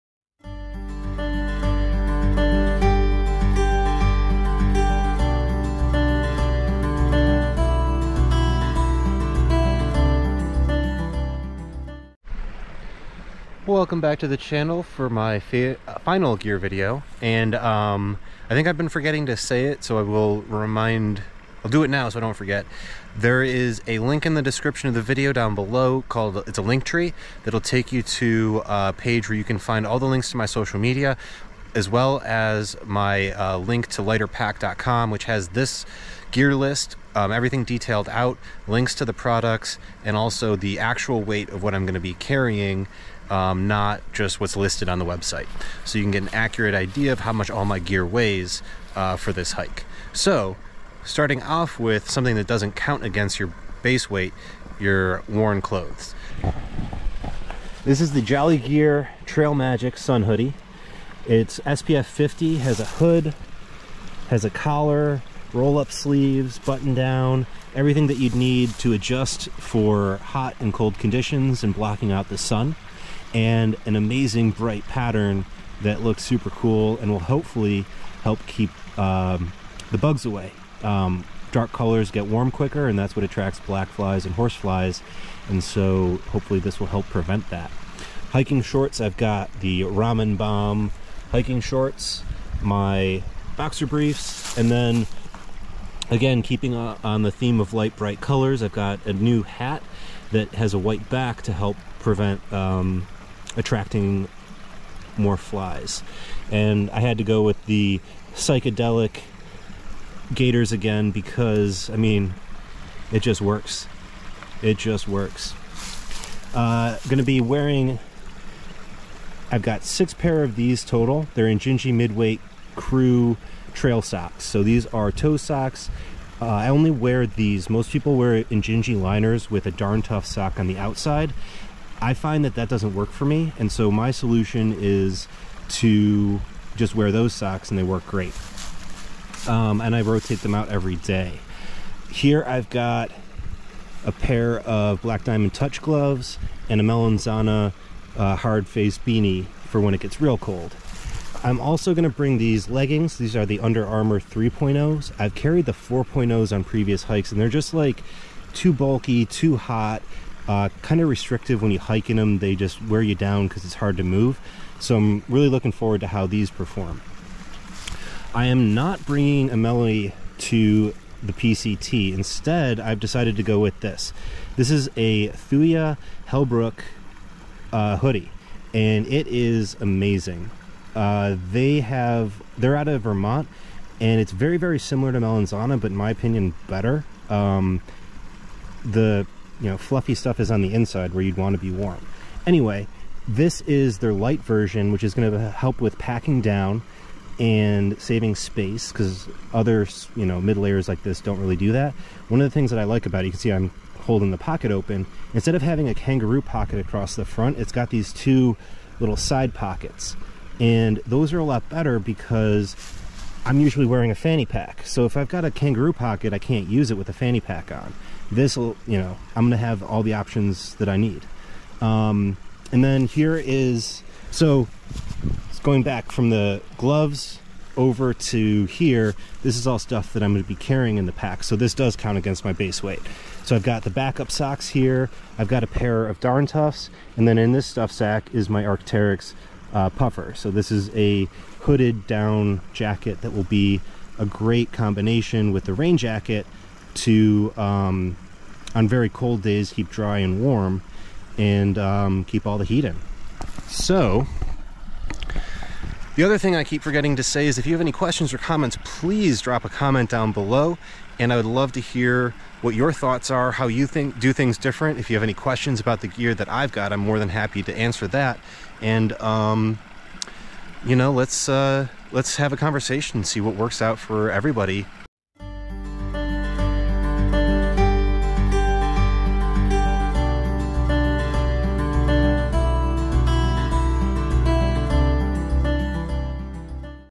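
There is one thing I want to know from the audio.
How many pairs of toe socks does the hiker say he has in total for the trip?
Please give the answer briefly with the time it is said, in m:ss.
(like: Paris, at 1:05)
6, at 1:59.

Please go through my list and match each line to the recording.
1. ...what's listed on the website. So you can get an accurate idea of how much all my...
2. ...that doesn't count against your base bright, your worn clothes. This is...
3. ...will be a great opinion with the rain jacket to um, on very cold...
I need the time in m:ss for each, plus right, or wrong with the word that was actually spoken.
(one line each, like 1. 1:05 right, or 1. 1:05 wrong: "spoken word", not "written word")
1. 0:44 right
2. 0:52 wrong: "weight", not "bright"
3. 4:03 wrong: "combination", not "opinion".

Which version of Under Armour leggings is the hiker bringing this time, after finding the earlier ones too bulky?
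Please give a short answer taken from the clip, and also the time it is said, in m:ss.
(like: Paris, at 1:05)
3.0, at 2:34.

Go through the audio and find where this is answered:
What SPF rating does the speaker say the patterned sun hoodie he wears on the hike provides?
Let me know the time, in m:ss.
1:01.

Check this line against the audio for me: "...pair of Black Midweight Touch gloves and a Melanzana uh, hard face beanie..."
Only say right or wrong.
wrong.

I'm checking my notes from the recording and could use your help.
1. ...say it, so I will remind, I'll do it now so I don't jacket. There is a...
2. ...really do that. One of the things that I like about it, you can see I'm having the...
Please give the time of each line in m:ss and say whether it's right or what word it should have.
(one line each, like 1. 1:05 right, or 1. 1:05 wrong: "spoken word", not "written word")
1. 0:19 wrong: "forget", not "jacket"
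2. 3:21 wrong: "holding", not "having".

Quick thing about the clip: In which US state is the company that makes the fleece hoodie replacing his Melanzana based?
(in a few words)
Vermont.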